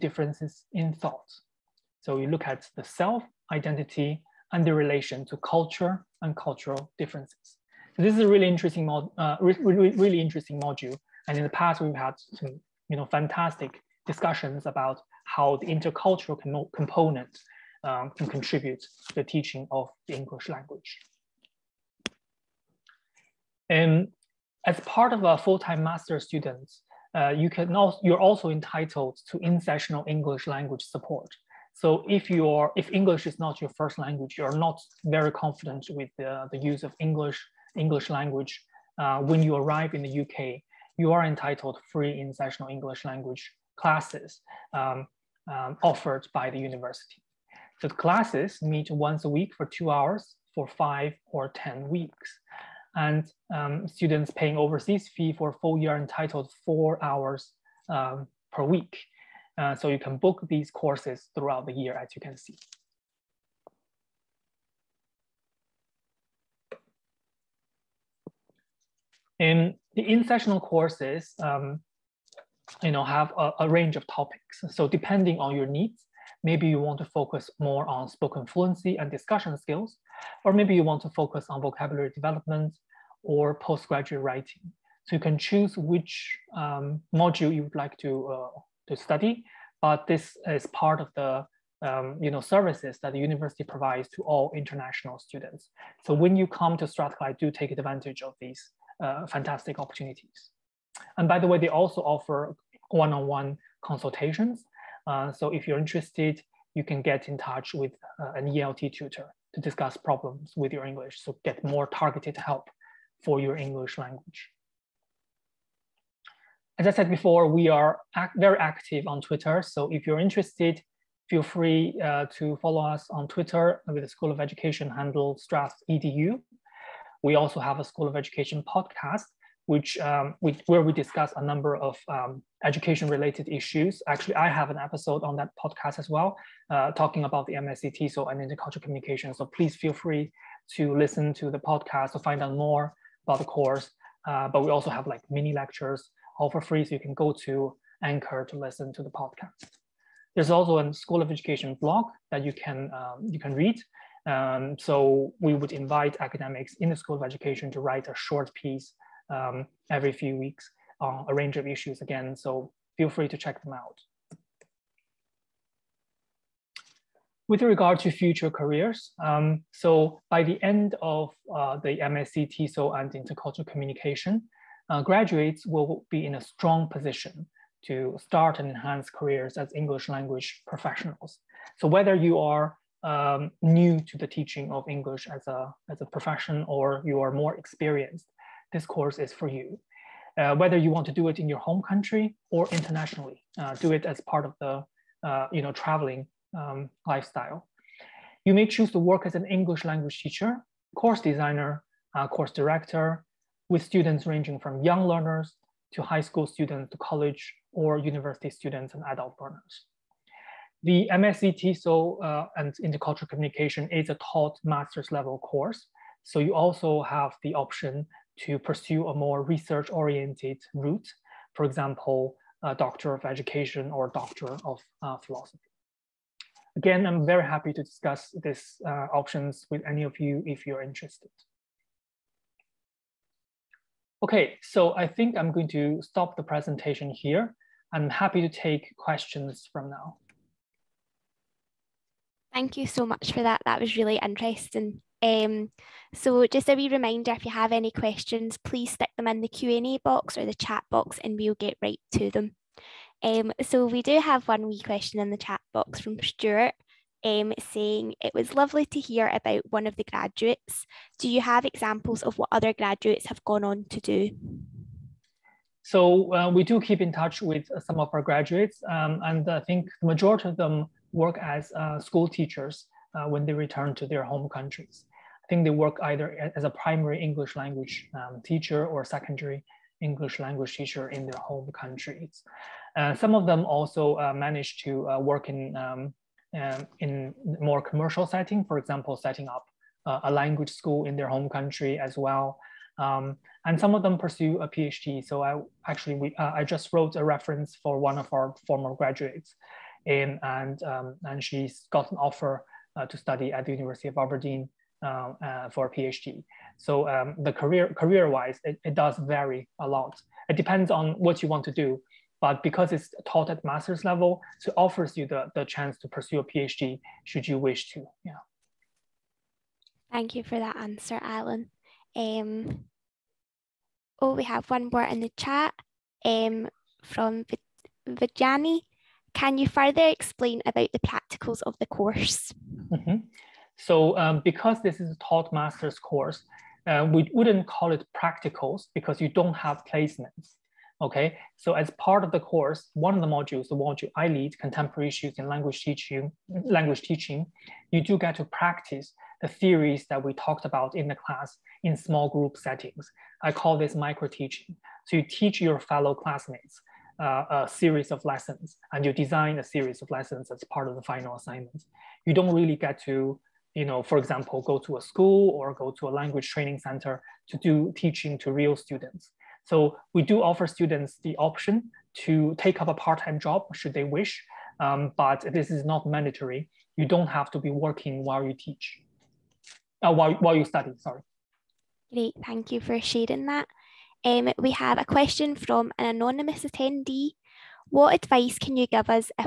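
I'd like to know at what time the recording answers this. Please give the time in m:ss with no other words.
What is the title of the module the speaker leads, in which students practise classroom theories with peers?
5:44.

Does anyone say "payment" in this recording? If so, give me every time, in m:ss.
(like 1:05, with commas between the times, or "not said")
not said.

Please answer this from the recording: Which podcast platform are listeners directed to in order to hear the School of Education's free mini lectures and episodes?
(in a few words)
Anchor.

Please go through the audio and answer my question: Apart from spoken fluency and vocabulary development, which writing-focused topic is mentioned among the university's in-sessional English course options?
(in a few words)
Postgraduate writing.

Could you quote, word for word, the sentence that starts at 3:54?
Okay, so I think I'm going to stop the presentation here.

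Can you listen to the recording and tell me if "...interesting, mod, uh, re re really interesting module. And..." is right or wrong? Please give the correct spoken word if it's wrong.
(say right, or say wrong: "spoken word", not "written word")
right.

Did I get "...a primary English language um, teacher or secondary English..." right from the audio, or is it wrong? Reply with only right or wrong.
right.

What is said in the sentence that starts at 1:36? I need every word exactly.
So when you come to Strathclyde, do take advantage of these uh, fantastic opportunities.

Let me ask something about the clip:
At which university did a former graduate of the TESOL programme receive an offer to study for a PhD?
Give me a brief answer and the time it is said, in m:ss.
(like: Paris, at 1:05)
University of Aberdeen, at 5:03.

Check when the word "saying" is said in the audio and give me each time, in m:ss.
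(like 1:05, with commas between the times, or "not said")
4:17.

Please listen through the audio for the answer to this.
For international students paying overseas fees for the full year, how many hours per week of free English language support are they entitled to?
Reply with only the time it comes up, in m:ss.
0:56.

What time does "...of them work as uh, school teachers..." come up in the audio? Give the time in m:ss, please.
4:30.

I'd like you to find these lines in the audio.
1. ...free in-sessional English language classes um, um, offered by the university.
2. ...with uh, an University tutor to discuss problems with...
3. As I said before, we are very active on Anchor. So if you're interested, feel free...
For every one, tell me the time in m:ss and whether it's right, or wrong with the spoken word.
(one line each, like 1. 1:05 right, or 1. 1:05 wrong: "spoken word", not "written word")
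1. 0:41 right
2. 1:47 wrong: "ELT", not "University"
3. 1:56 wrong: "Twitter", not "Anchor".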